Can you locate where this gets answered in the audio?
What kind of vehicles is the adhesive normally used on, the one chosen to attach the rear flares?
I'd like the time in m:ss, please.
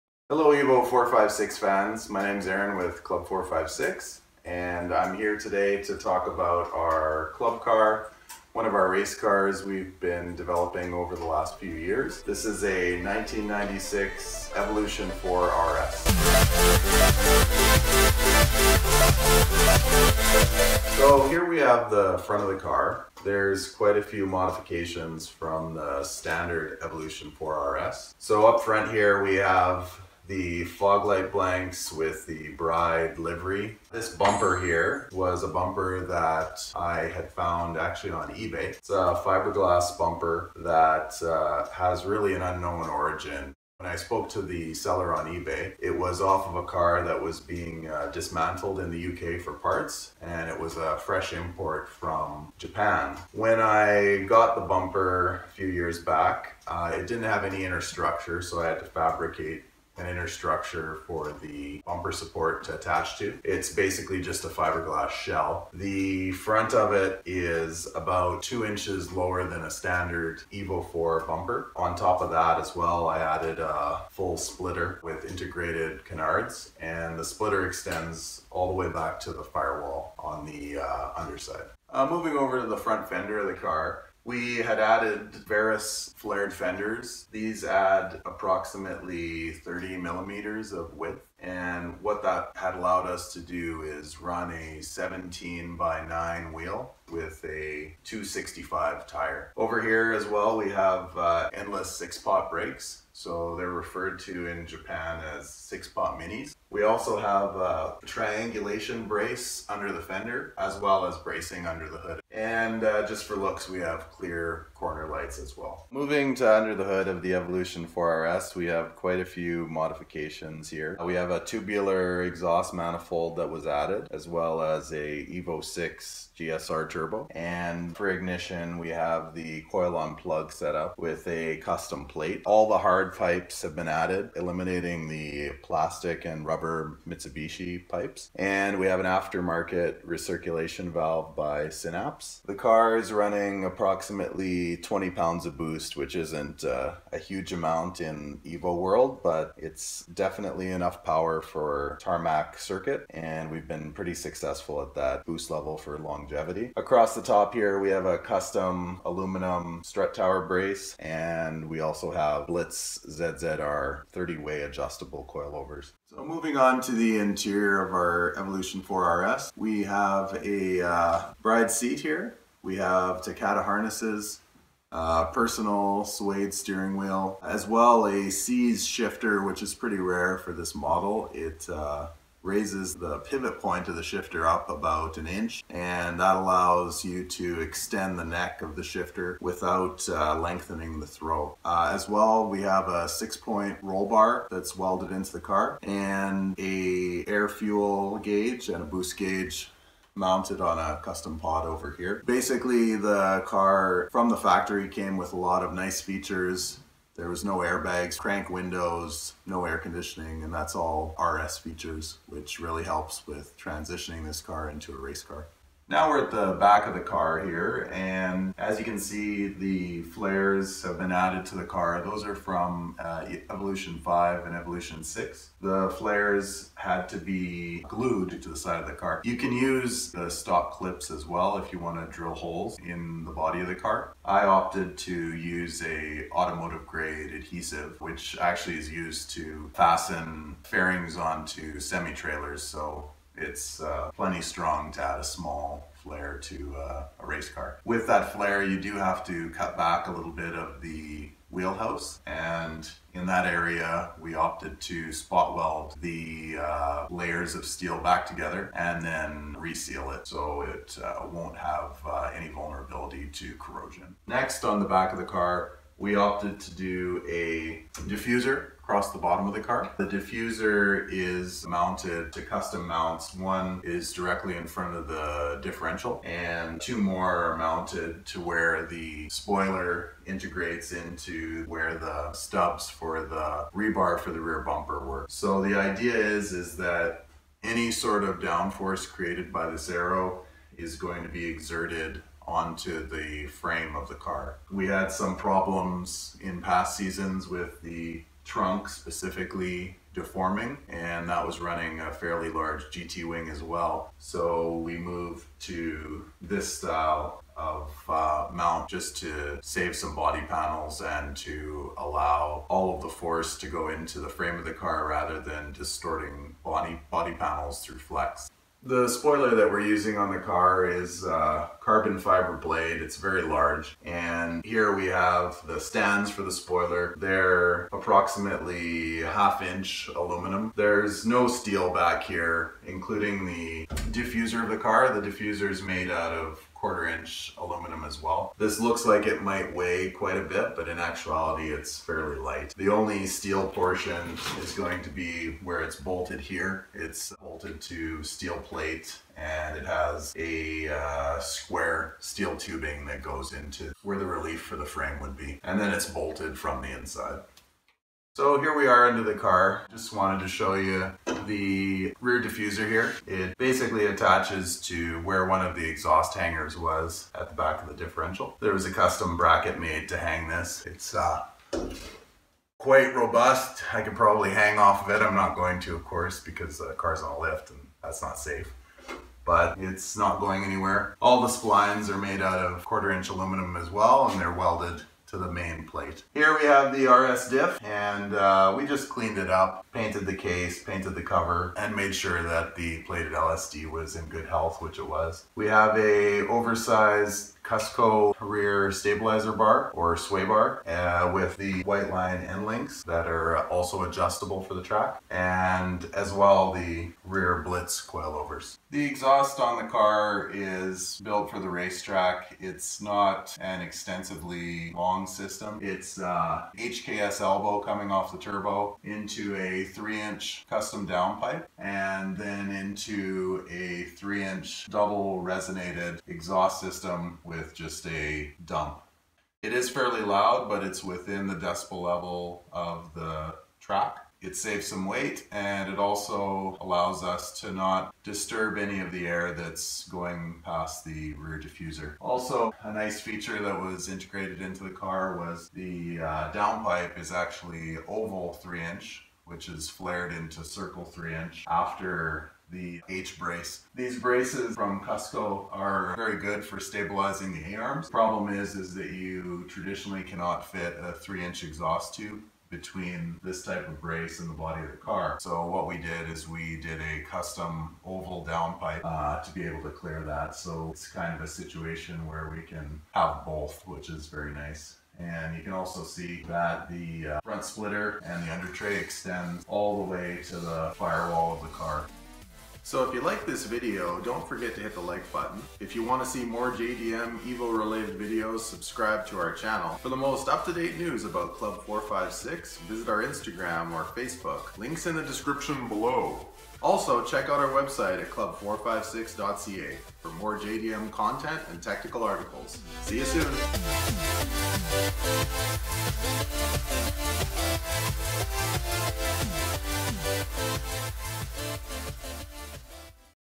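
4:01.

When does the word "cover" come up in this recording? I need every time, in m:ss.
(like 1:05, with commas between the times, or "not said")
6:31.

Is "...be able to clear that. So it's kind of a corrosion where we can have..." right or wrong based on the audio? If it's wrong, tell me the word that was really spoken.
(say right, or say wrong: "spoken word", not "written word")
wrong: "situation", not "corrosion".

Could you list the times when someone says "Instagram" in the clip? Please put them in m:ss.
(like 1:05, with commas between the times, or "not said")
8:13.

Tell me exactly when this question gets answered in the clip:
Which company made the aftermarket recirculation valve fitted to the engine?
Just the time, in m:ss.
2:21.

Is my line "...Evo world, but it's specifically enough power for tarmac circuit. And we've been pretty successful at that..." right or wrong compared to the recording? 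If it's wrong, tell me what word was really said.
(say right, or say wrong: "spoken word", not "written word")
wrong: "definitely", not "specifically".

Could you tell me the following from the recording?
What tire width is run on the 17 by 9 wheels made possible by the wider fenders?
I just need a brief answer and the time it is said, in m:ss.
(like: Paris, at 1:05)
265, at 1:38.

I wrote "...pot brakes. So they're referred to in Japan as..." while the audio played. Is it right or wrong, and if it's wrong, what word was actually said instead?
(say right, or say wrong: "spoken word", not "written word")
right.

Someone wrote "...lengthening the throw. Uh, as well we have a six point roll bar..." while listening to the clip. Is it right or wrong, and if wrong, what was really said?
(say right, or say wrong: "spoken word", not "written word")
right.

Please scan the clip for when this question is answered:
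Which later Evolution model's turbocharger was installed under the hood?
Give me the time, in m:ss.
2:05.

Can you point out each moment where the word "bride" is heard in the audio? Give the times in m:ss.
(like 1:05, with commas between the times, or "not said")
0:32, 2:51.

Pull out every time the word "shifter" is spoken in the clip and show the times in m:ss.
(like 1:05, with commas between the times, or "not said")
2:58, 3:04, 3:08.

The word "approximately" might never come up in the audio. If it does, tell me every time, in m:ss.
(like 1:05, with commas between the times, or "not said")
1:28, 2:23, 5:27.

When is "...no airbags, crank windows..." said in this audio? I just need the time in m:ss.
3:27.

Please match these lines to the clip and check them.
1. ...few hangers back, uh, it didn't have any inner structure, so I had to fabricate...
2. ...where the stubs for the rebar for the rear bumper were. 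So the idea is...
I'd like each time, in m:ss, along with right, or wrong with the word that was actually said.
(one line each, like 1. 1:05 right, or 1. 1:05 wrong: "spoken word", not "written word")
1. 0:55 wrong: "years", not "hangers"
2. 4:41 right.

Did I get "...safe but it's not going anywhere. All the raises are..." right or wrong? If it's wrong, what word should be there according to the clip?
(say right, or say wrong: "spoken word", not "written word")
wrong: "splines", not "raises".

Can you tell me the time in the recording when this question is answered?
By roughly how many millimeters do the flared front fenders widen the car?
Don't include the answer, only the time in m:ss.
1:29.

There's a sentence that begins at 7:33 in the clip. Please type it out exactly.
These braces from Cusco are very good for stabilizing the A-arms.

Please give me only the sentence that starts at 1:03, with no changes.
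It's basically just a fiberglass shell.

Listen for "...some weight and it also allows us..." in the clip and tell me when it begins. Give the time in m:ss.
7:14.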